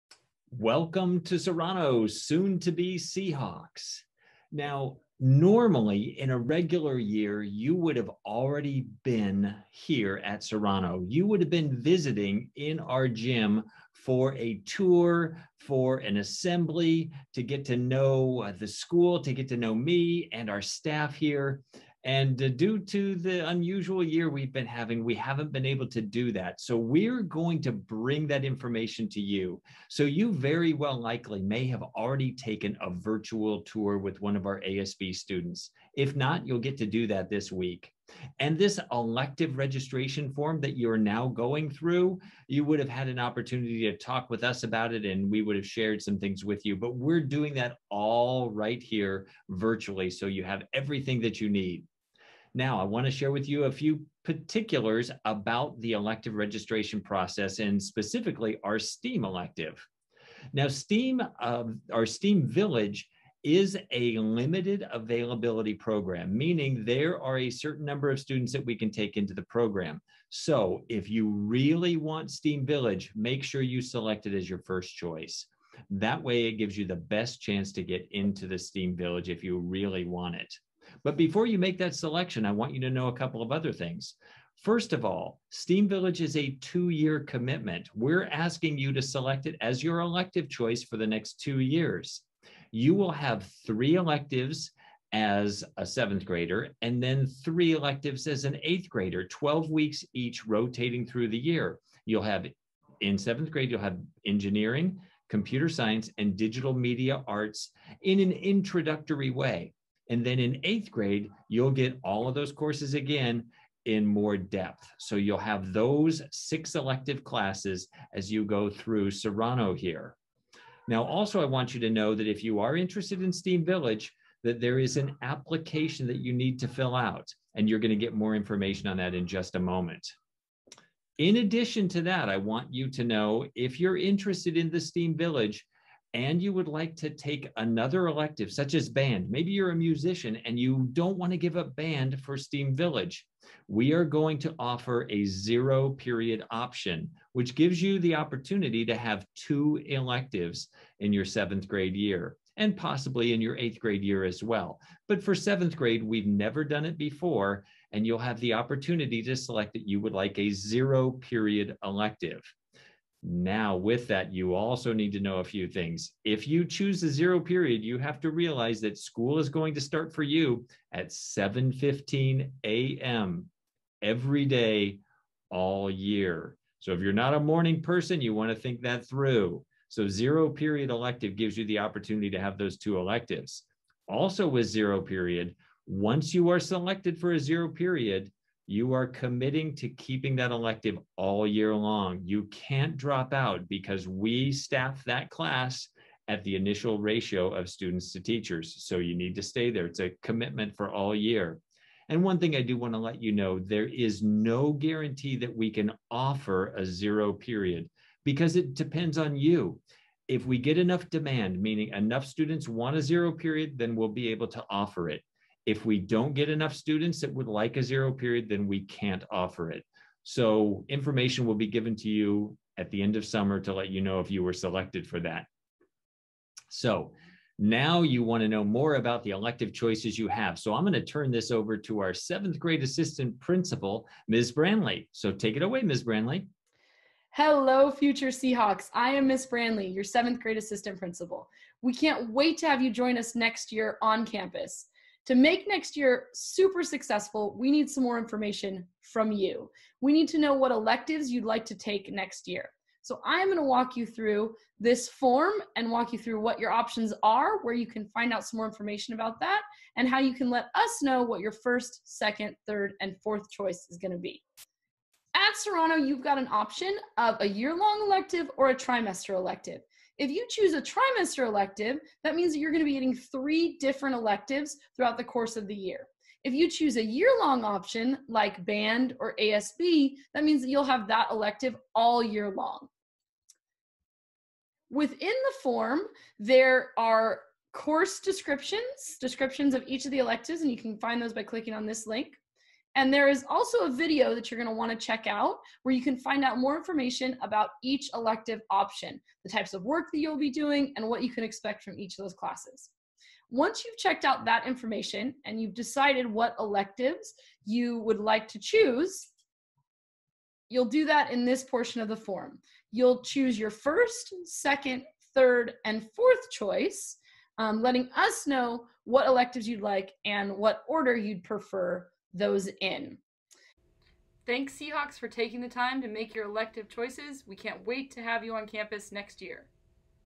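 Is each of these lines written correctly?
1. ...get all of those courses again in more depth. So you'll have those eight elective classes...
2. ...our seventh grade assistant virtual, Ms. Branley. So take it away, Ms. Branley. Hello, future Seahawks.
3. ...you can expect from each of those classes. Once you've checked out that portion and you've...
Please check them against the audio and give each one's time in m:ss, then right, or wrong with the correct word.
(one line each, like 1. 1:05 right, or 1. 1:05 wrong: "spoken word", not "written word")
1. 1:51 wrong: "six", not "eight"
2. 3:51 wrong: "principal", not "virtual"
3. 5:01 wrong: "information", not "portion".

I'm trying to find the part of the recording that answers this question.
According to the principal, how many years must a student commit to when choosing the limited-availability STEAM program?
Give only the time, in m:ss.
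1:26.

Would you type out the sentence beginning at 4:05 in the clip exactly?
To make next year super successful, we need some more information from you.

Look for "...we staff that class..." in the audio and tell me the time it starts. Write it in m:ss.
3:14.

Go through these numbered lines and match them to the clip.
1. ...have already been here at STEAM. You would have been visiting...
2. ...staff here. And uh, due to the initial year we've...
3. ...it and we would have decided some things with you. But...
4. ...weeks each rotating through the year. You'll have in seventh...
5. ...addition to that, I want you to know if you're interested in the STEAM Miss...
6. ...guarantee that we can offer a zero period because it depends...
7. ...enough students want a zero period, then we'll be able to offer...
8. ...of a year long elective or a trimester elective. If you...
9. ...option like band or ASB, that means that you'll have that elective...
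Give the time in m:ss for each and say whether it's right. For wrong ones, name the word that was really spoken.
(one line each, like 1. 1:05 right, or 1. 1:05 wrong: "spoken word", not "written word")
1. 0:07 wrong: "Serrano", not "STEAM"
2. 0:20 wrong: "unusual", not "initial"
3. 0:44 wrong: "shared", not "decided"
4. 1:39 right
5. 2:11 wrong: "Village", not "Miss"
6. 3:24 right
7. 3:31 right
8. 4:27 right
9. 4:37 right.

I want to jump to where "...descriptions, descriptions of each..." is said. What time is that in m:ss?
4:48.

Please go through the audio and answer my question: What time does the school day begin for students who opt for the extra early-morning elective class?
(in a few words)
7:15 a.m.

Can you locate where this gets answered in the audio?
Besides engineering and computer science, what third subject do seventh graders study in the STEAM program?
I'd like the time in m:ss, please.
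1:46.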